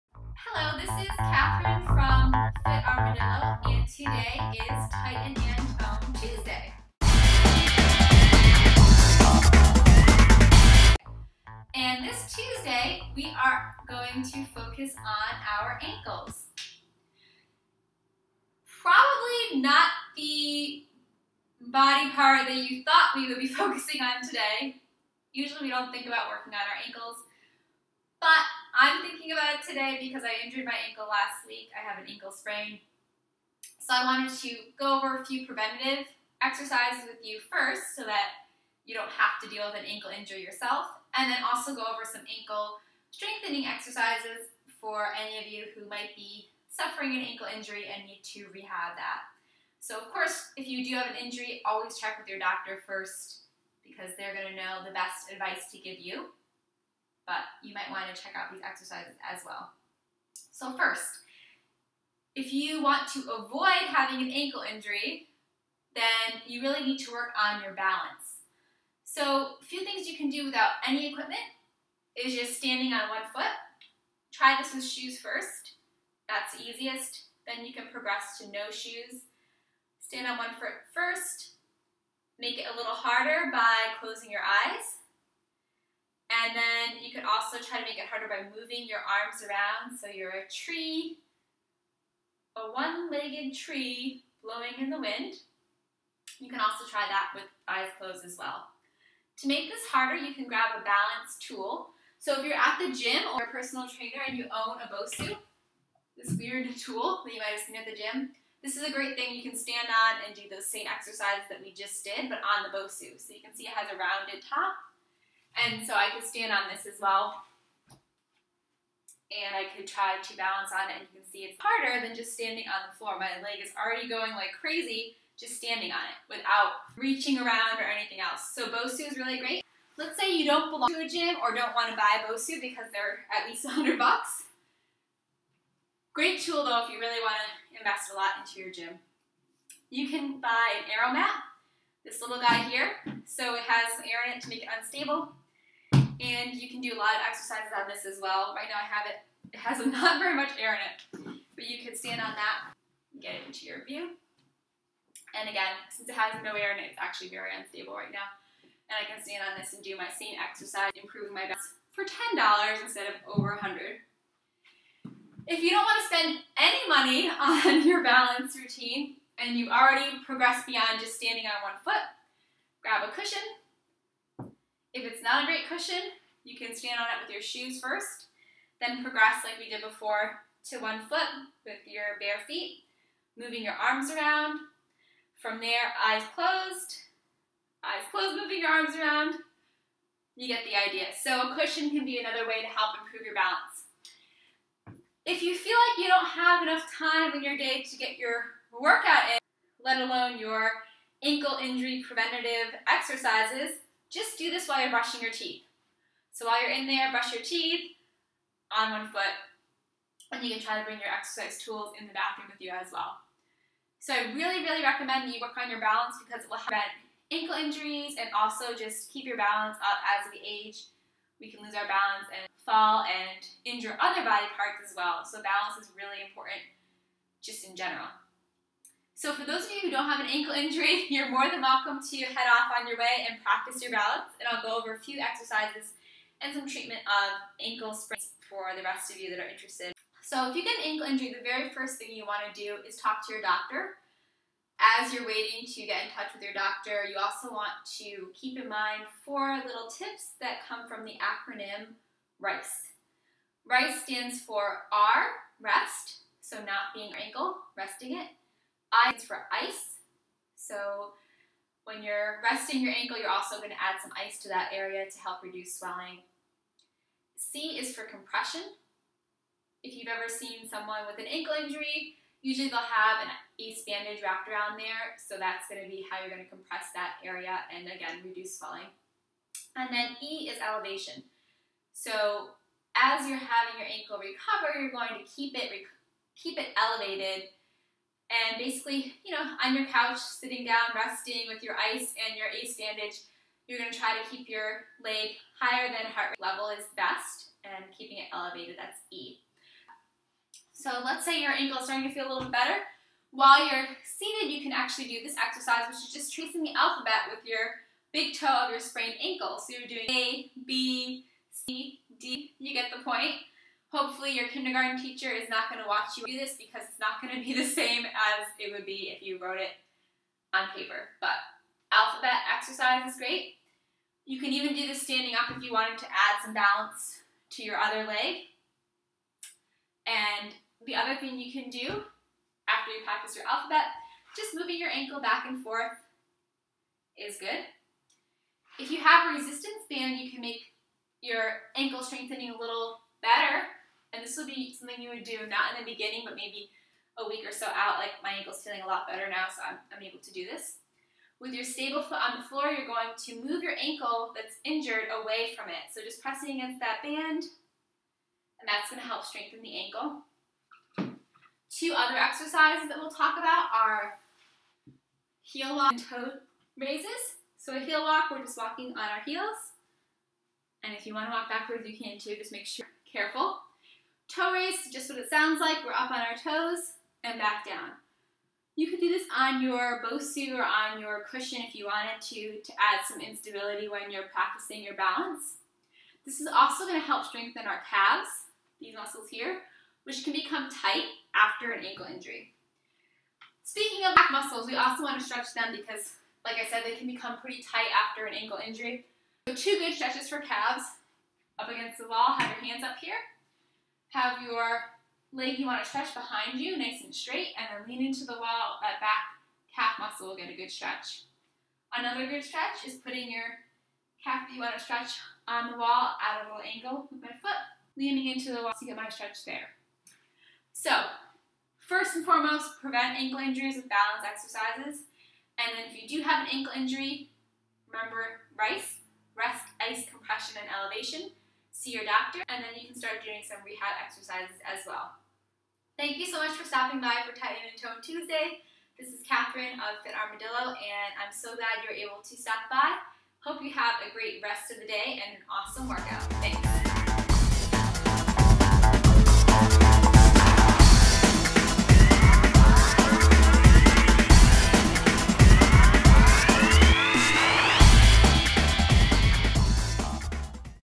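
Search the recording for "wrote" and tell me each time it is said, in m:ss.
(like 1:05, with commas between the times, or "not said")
5:19.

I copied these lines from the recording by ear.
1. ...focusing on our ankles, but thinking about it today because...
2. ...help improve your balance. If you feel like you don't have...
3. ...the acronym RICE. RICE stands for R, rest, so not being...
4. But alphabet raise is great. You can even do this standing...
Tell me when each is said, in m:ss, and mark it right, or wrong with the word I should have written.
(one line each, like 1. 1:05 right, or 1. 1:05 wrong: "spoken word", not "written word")
1. 0:26 wrong: "working", not "focusing"
2. 3:12 right
3. 4:11 right
4. 5:21 wrong: "exercise", not "raise".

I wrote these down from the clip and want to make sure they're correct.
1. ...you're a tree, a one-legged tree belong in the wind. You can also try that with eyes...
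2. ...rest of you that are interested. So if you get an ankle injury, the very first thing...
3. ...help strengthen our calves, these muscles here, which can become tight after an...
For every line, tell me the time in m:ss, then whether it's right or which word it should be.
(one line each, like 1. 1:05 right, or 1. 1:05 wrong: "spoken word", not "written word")
1. 1:30 wrong: "blowing", not "belong"
2. 3:58 right
3. 6:27 right.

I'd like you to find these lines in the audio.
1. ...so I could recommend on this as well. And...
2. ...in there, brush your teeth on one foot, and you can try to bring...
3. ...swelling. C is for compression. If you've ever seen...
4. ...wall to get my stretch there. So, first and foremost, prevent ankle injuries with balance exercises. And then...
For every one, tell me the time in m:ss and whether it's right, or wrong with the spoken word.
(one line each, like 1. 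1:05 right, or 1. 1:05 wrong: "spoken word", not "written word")
1. 1:55 wrong: "stand", not "recommend"
2. 3:26 right
3. 4:25 right
4. 6:58 right.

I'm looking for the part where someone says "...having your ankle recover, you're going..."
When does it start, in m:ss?
4:43.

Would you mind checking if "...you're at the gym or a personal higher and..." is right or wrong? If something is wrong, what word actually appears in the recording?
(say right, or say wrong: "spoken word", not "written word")
wrong: "trainer", not "higher".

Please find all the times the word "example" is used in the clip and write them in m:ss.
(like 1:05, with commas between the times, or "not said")
not said.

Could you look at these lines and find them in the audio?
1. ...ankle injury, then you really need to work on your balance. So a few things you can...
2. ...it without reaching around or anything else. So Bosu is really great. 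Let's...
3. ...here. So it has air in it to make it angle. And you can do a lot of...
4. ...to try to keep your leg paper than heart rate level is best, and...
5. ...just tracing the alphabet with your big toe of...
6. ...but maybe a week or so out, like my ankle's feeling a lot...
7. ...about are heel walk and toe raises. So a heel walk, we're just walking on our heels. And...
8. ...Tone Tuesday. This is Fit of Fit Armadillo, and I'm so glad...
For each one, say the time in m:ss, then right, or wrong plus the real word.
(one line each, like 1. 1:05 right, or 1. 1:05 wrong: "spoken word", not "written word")
1. 1:04 right
2. 2:06 right
3. 2:22 wrong: "unstable", not "angle"
4. 4:53 wrong: "higher", not "paper"
5. 5:06 right
6. 5:46 right
7. 6:03 right
8. 7:17 wrong: "Catherine", not "Fit".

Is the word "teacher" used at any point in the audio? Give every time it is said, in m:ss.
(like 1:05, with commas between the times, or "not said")
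5:14.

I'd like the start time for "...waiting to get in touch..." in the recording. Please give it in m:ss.
4:05.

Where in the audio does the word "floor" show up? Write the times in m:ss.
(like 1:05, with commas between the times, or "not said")
2:02, 5:52.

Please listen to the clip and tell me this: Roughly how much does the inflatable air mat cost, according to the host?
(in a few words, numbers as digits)
$10.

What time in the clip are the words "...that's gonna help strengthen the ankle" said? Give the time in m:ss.
5:58.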